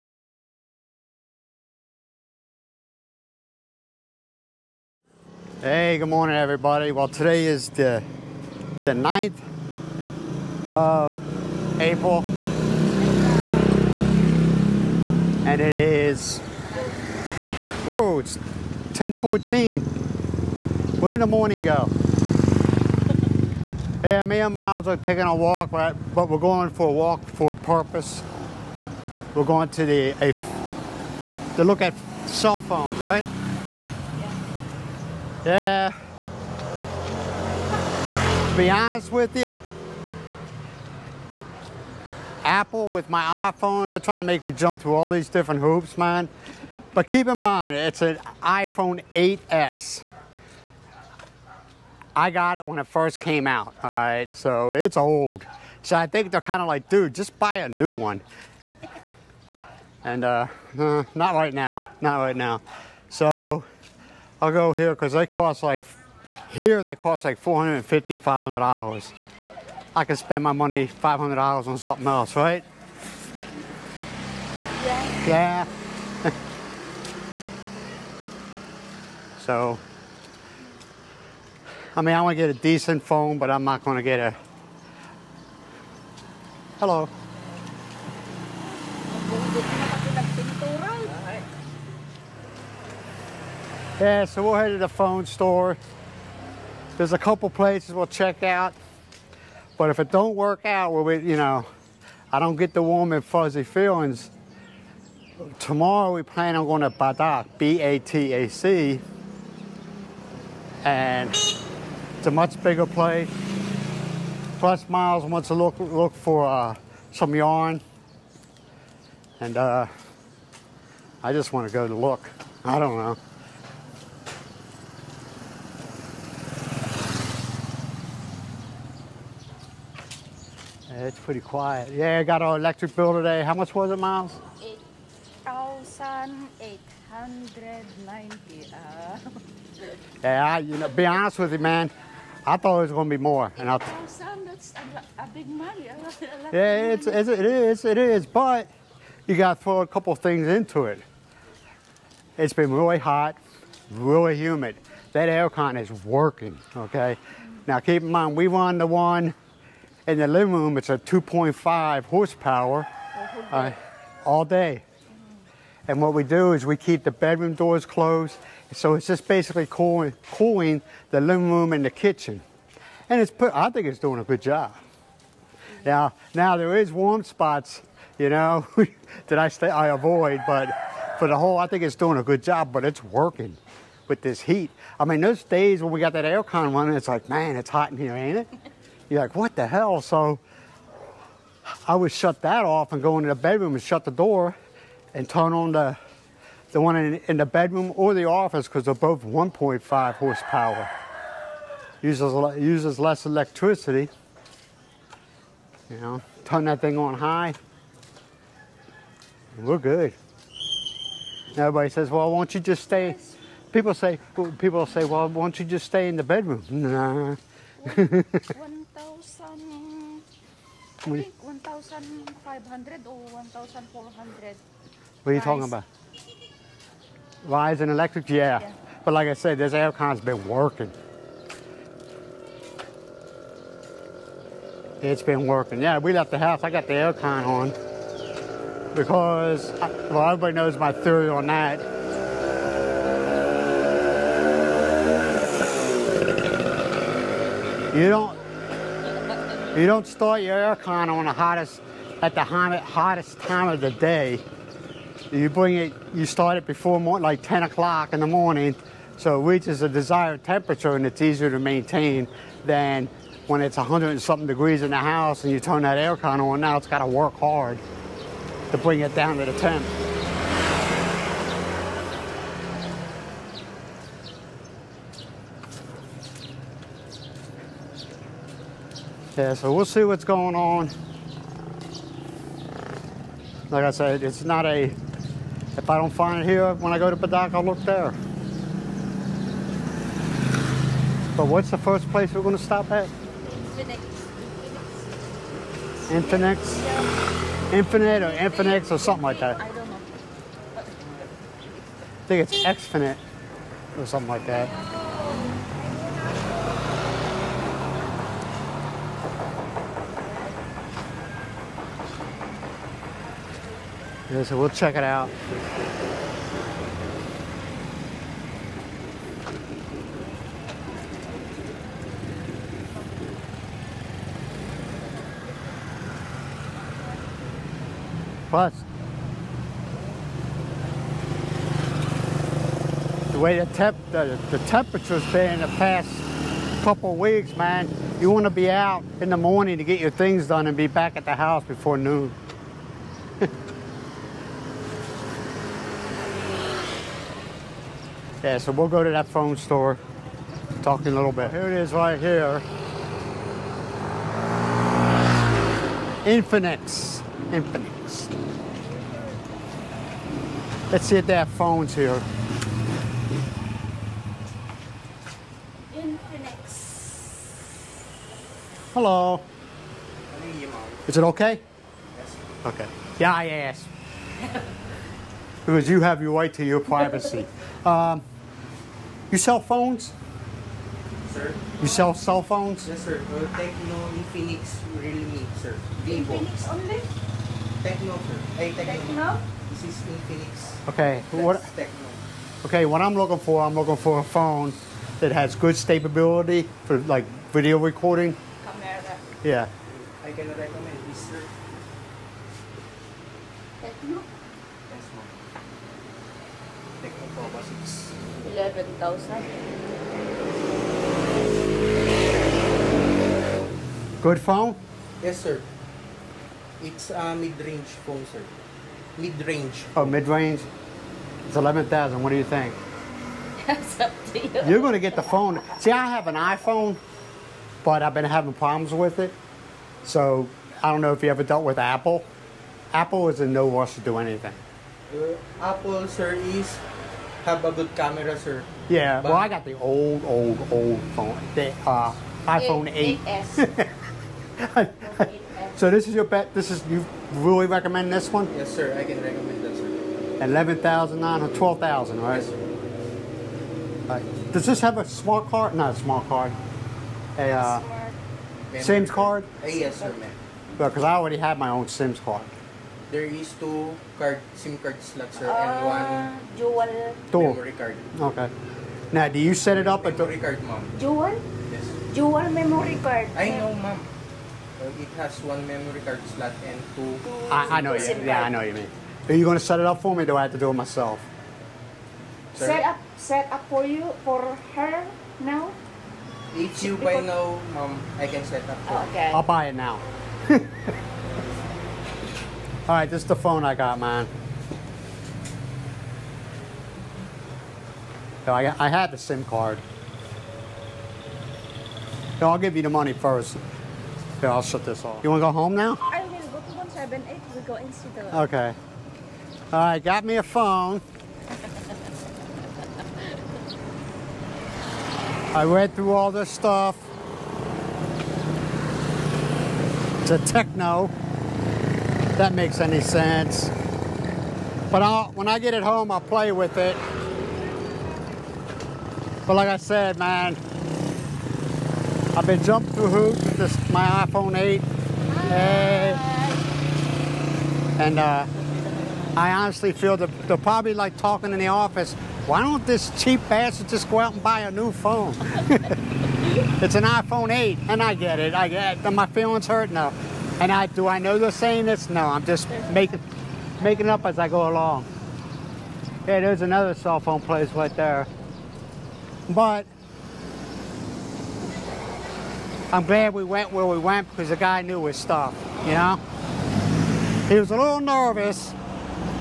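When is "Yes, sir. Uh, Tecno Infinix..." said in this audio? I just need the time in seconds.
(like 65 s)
382 s.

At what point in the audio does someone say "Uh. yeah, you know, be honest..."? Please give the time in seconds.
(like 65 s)
138 s.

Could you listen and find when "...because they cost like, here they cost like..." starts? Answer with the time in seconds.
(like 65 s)
64 s.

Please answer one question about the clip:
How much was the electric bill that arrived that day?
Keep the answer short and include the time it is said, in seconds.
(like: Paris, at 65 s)
8,890, at 135 s.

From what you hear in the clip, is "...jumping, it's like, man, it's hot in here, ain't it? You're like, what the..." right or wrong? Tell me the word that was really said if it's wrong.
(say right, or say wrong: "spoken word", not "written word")
wrong: "running", not "jumping".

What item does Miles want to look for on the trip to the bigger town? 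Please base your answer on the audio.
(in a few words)
yarn.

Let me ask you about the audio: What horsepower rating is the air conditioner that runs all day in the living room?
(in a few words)
2.5 horsepower.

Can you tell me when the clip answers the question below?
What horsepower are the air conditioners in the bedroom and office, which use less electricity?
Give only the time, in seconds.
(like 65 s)
199 s.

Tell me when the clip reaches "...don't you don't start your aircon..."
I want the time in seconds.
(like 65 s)
248 s.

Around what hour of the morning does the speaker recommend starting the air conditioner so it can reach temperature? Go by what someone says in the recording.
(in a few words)
10 o'clock.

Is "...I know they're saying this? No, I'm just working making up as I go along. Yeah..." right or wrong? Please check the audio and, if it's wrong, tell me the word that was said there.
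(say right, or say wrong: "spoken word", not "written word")
wrong: "making", not "working".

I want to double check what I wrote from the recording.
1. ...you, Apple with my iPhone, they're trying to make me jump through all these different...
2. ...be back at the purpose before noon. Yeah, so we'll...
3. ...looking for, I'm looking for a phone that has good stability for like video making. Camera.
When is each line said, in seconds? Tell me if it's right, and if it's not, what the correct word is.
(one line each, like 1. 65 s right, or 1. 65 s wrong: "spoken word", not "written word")
1. 39 s right
2. 340 s wrong: "house", not "purpose"
3. 393 s wrong: "recording", not "making".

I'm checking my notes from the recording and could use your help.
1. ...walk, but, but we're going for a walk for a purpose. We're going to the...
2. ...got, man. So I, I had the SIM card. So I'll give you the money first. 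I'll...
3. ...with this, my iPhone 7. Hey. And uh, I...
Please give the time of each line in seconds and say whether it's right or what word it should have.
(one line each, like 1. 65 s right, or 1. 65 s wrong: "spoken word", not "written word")
1. 25 s right
2. 493 s right
3. 533 s wrong: "8", not "7".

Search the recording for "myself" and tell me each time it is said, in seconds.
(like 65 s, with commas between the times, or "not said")
480 s.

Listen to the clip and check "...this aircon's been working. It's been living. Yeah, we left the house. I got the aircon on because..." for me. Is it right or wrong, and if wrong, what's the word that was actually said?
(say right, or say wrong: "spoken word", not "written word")
wrong: "working", not "living".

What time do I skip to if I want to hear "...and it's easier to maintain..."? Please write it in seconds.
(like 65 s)
260 s.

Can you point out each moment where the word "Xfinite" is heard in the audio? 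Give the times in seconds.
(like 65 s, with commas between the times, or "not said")
302 s.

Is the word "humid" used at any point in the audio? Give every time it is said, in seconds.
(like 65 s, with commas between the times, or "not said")
154 s.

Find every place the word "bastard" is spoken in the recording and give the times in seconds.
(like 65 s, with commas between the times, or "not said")
543 s.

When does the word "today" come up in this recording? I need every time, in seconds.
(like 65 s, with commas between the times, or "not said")
7 s, 133 s.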